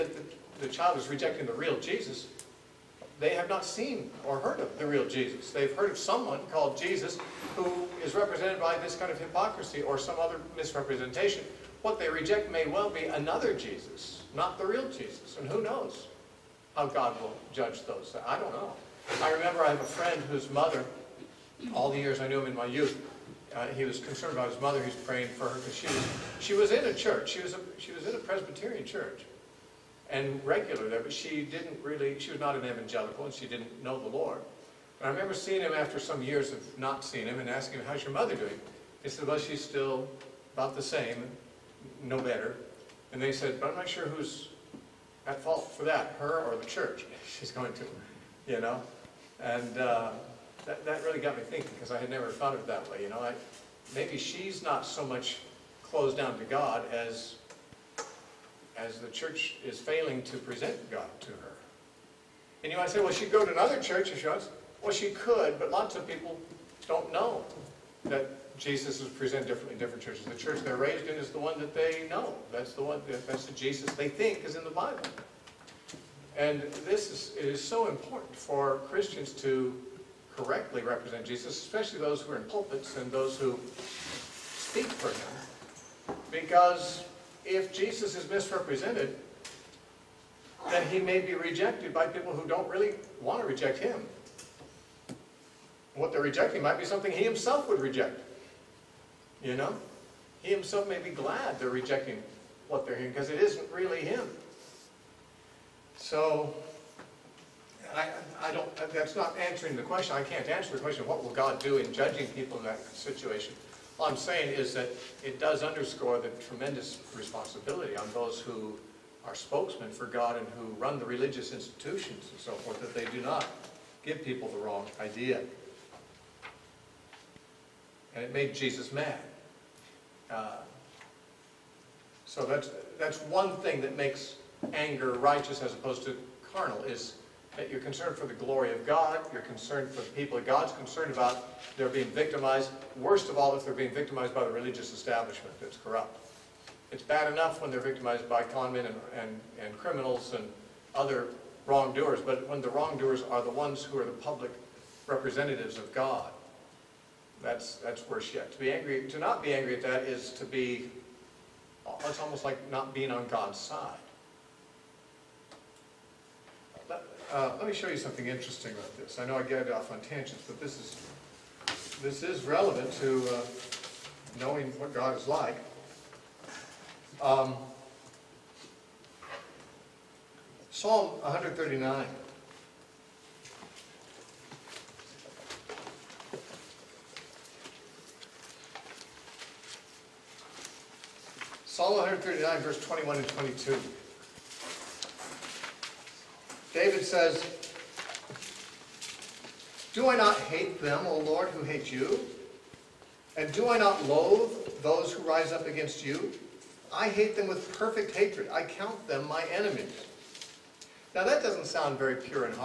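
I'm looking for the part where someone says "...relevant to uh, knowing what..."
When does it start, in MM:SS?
02:52.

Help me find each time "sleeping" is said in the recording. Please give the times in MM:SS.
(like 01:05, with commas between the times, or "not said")
not said.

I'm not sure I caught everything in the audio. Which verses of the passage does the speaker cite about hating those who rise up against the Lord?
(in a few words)
21 and 22.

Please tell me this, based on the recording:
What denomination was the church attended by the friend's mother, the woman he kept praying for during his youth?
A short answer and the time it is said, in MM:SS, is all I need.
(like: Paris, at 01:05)
Presbyterian, at 00:28.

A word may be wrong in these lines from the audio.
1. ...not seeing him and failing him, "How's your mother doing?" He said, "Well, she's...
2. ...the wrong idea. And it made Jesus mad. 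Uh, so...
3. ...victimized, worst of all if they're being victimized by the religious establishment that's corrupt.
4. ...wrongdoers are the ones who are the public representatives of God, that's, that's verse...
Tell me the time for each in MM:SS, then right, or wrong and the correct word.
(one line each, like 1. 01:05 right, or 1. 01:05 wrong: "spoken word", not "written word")
1. 00:36 wrong: "asking", not "failing"
2. 02:04 right
3. 02:22 right
4. 02:32 wrong: "worse", not "verse".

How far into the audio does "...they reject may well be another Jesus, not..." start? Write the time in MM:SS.
00:11.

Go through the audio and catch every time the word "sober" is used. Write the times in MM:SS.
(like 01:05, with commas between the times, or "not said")
not said.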